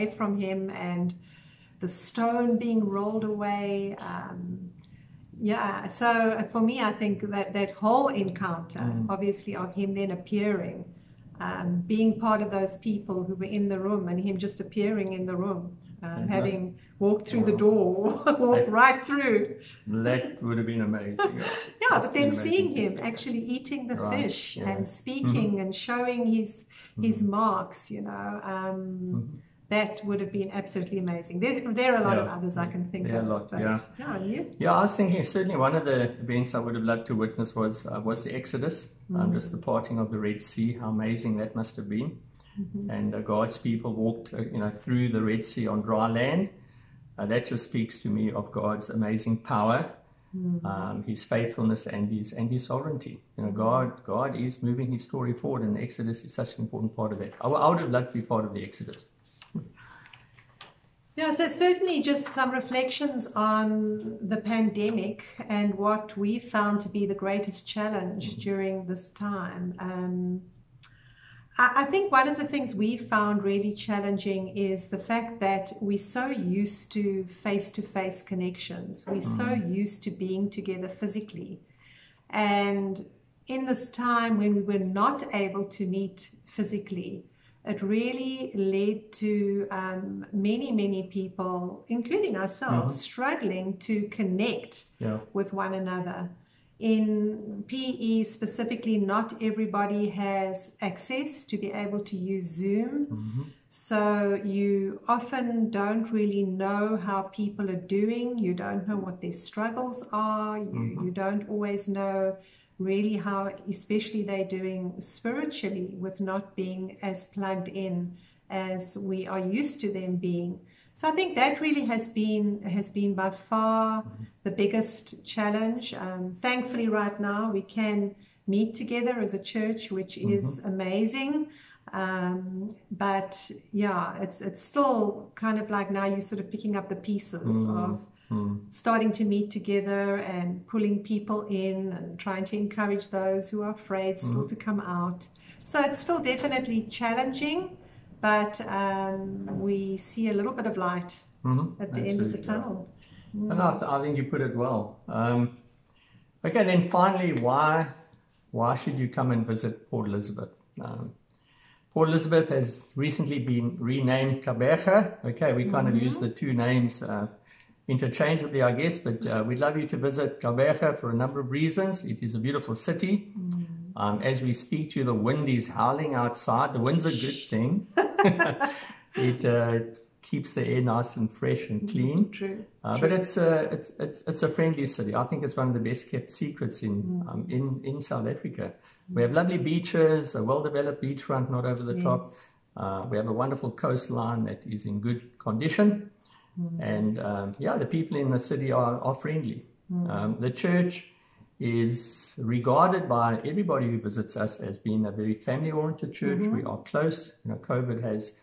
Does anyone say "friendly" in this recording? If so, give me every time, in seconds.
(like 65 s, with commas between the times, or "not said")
184 s, 199 s.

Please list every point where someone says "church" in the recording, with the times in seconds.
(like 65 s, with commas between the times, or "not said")
129 s, 200 s, 206 s.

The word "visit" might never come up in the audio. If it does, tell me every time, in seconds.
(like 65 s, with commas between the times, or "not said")
159 s, 169 s, 203 s.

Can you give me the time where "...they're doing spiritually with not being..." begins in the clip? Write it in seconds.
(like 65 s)
114 s.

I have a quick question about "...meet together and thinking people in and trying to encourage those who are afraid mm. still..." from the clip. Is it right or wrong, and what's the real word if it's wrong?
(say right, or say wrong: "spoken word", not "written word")
wrong: "pulling", not "thinking".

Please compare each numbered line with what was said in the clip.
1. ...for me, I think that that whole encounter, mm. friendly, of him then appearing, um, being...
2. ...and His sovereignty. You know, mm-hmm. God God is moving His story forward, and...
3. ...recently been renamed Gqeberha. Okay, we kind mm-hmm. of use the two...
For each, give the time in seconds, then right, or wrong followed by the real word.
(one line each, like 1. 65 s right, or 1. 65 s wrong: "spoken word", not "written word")
1. 6 s wrong: "obviously", not "friendly"
2. 52 s right
3. 162 s right.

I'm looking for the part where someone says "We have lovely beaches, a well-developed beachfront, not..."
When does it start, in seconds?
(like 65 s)
189 s.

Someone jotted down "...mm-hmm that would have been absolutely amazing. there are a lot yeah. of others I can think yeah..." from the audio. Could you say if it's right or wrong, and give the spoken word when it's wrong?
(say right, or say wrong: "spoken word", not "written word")
right.